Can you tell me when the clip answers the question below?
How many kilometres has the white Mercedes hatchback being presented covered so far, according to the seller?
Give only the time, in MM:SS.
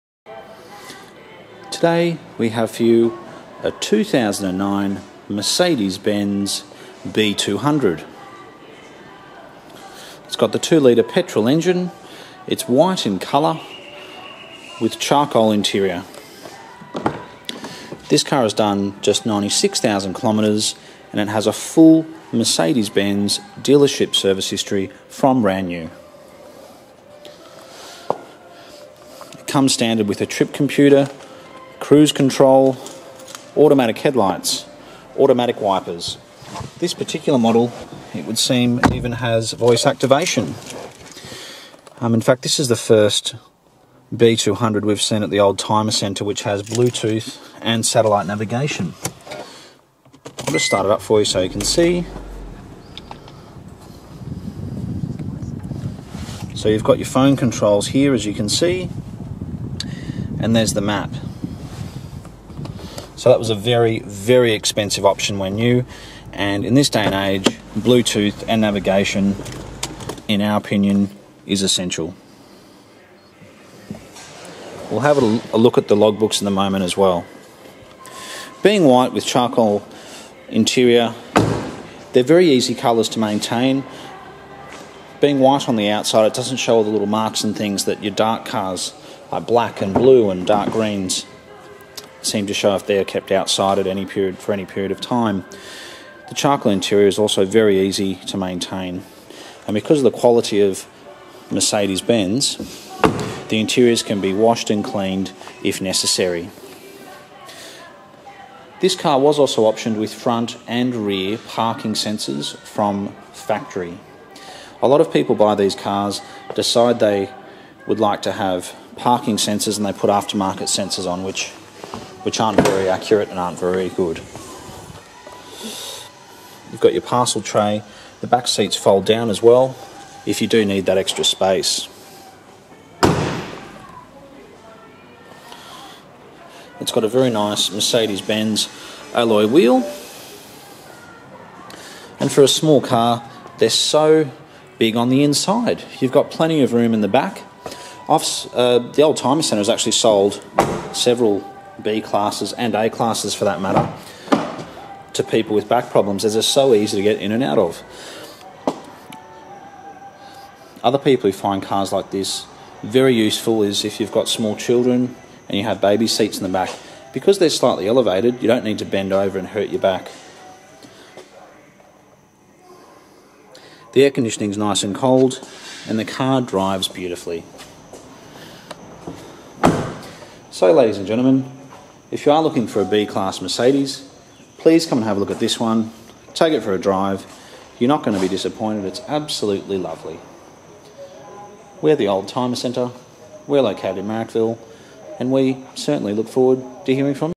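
00:19.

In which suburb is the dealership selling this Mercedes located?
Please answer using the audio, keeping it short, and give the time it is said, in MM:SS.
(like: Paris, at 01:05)
Marrickville, at 03:14.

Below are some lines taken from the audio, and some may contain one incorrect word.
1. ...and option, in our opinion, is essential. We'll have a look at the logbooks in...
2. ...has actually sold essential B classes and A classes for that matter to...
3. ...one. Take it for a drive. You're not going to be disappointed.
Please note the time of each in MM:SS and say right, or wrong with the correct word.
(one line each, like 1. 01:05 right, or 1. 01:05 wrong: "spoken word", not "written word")
1. 01:08 wrong: "navigation", not "option"
2. 02:29 wrong: "several", not "essential"
3. 03:05 right.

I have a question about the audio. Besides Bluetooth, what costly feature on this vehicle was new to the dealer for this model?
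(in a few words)
Satellite navigation.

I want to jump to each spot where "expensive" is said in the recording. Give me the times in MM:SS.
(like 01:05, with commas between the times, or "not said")
01:04.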